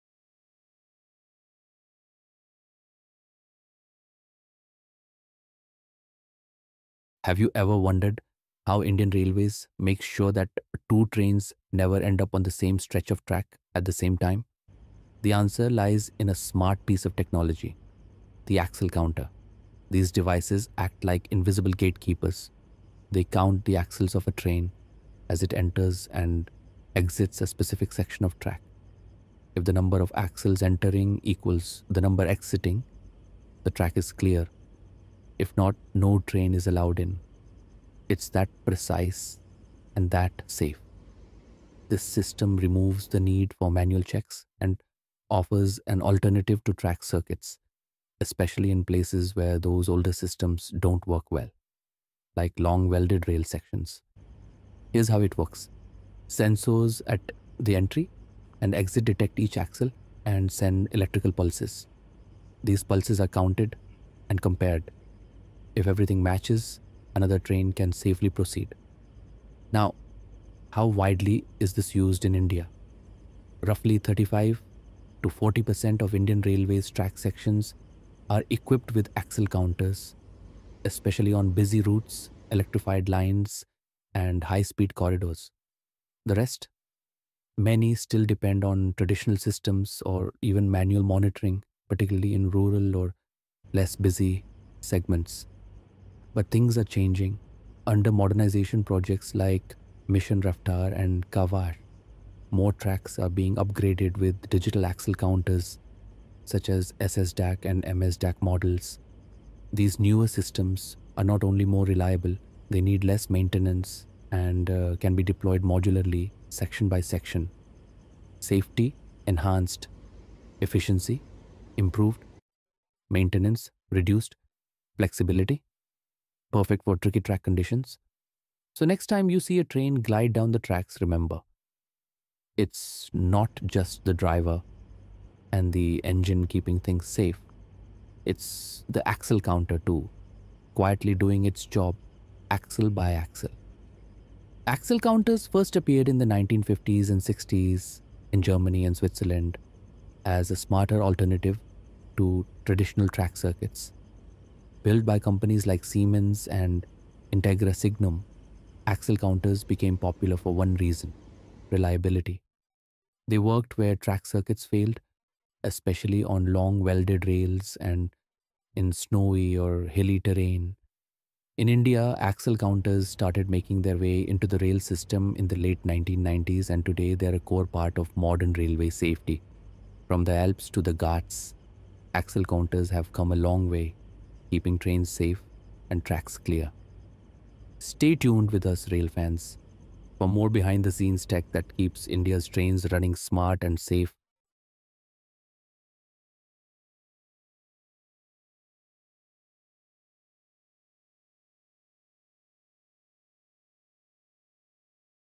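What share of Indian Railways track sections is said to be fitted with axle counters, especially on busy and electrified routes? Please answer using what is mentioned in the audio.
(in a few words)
35 to 40%.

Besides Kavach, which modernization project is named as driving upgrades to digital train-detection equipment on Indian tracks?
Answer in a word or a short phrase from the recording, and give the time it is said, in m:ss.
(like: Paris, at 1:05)
Mission Raftaar, at 1:40.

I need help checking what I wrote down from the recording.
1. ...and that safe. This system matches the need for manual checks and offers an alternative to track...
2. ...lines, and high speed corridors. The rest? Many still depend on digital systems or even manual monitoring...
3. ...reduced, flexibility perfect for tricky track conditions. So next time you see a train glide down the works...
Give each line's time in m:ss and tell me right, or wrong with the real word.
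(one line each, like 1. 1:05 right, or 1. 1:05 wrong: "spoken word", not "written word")
1. 0:39 wrong: "removes", not "matches"
2. 1:23 wrong: "traditional", not "digital"
3. 2:03 wrong: "tracks", not "works".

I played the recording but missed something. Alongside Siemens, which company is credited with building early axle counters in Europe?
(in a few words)
Integra Signum.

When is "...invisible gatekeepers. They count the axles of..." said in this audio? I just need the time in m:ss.
0:21.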